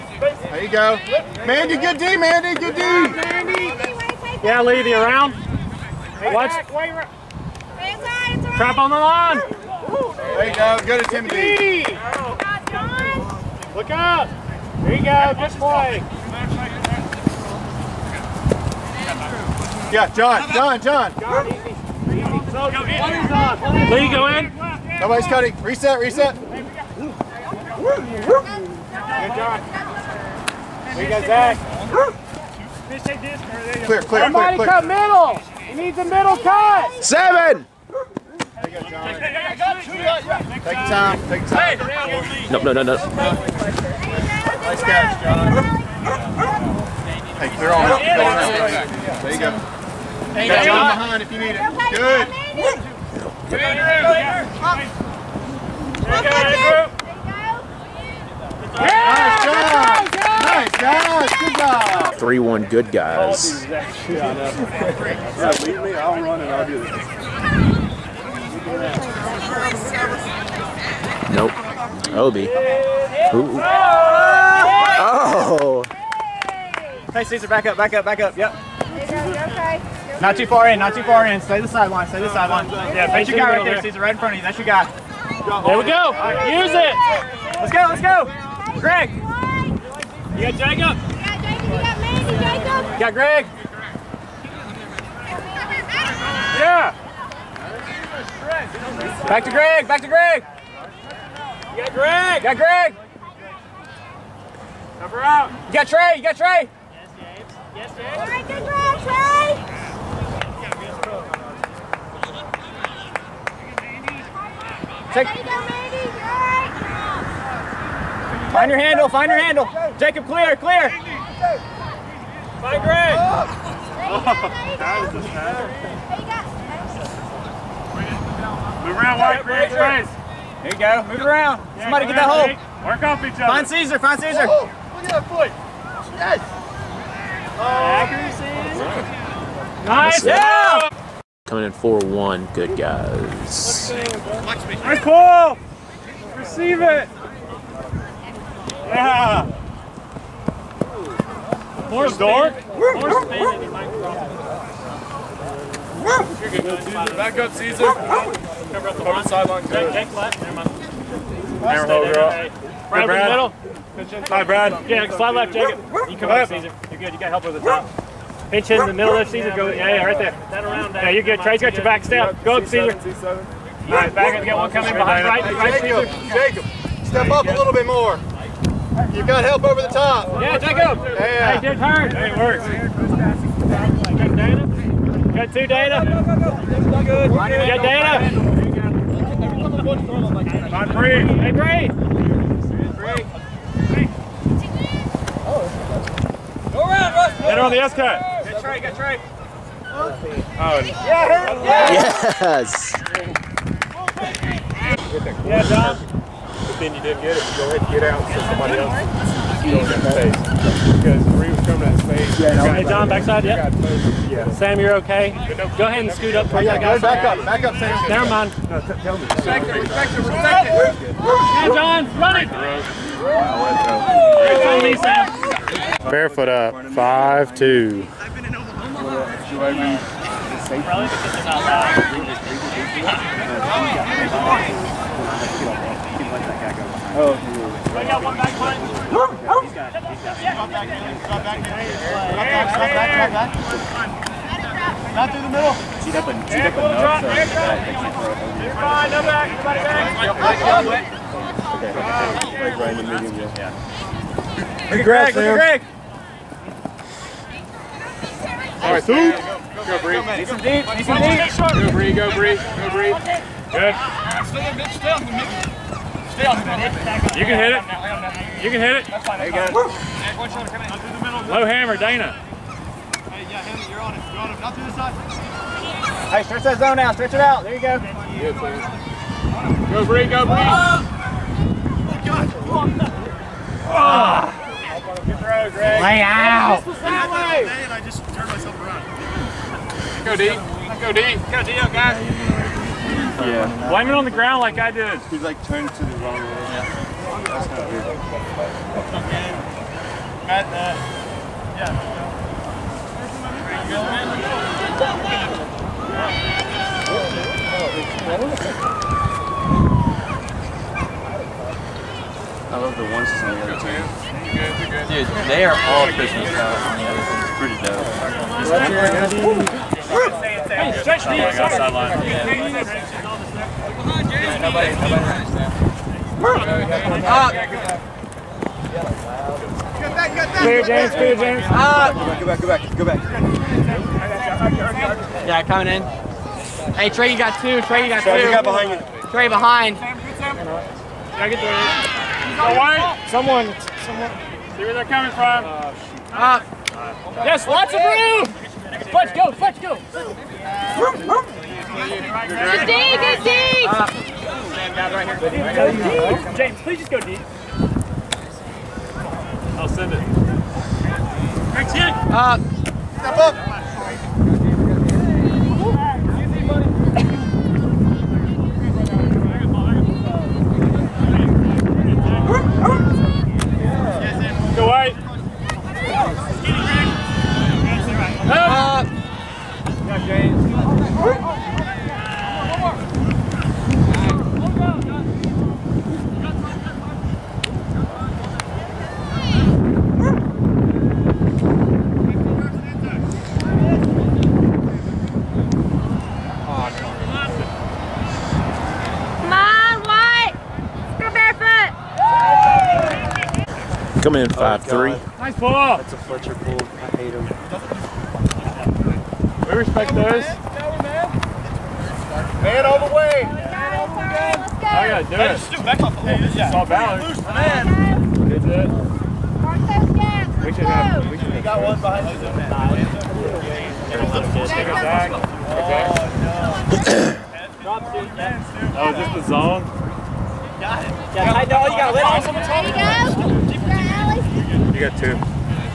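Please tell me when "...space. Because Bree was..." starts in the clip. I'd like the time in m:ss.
3:30.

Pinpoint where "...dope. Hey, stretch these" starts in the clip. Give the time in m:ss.
5:20.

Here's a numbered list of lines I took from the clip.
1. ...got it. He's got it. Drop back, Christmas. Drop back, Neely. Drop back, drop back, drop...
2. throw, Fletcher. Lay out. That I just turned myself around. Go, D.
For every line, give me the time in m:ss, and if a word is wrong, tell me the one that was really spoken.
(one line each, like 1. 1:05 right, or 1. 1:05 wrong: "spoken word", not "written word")
1. 3:59 wrong: "Neely", not "Christmas"
2. 4:45 wrong: "Greg", not "Fletcher".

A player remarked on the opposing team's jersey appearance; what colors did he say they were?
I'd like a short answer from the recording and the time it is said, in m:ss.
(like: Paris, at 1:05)
Christmas colors, at 5:16.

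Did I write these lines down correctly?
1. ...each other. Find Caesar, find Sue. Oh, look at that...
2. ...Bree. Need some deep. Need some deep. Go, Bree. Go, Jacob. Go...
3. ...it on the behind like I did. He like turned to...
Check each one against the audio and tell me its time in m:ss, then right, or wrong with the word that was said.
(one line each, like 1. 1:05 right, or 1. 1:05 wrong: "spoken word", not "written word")
1. 2:13 wrong: "Caesar", not "Sue"
2. 4:20 wrong: "Bree", not "Jacob"
3. 4:54 wrong: "ground", not "behind".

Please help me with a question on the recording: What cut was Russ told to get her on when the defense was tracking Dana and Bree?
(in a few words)
S cut.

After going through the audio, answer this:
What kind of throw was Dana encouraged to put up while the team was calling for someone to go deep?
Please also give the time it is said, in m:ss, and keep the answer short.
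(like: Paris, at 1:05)
Low hammer, at 4:31.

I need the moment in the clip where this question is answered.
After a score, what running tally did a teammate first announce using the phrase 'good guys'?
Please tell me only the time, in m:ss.
1:02.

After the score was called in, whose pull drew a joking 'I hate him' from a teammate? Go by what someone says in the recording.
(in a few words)
Fletcher.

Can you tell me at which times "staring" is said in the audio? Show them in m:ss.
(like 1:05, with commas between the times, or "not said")
not said.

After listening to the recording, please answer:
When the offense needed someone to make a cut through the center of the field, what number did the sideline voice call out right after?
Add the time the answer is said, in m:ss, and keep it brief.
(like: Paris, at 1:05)
7, at 0:37.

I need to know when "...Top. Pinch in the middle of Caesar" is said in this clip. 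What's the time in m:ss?
2:47.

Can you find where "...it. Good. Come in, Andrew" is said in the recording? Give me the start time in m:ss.
0:51.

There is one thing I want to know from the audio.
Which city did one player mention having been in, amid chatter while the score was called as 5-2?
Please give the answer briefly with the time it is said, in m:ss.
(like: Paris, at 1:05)
Omaha, at 3:48.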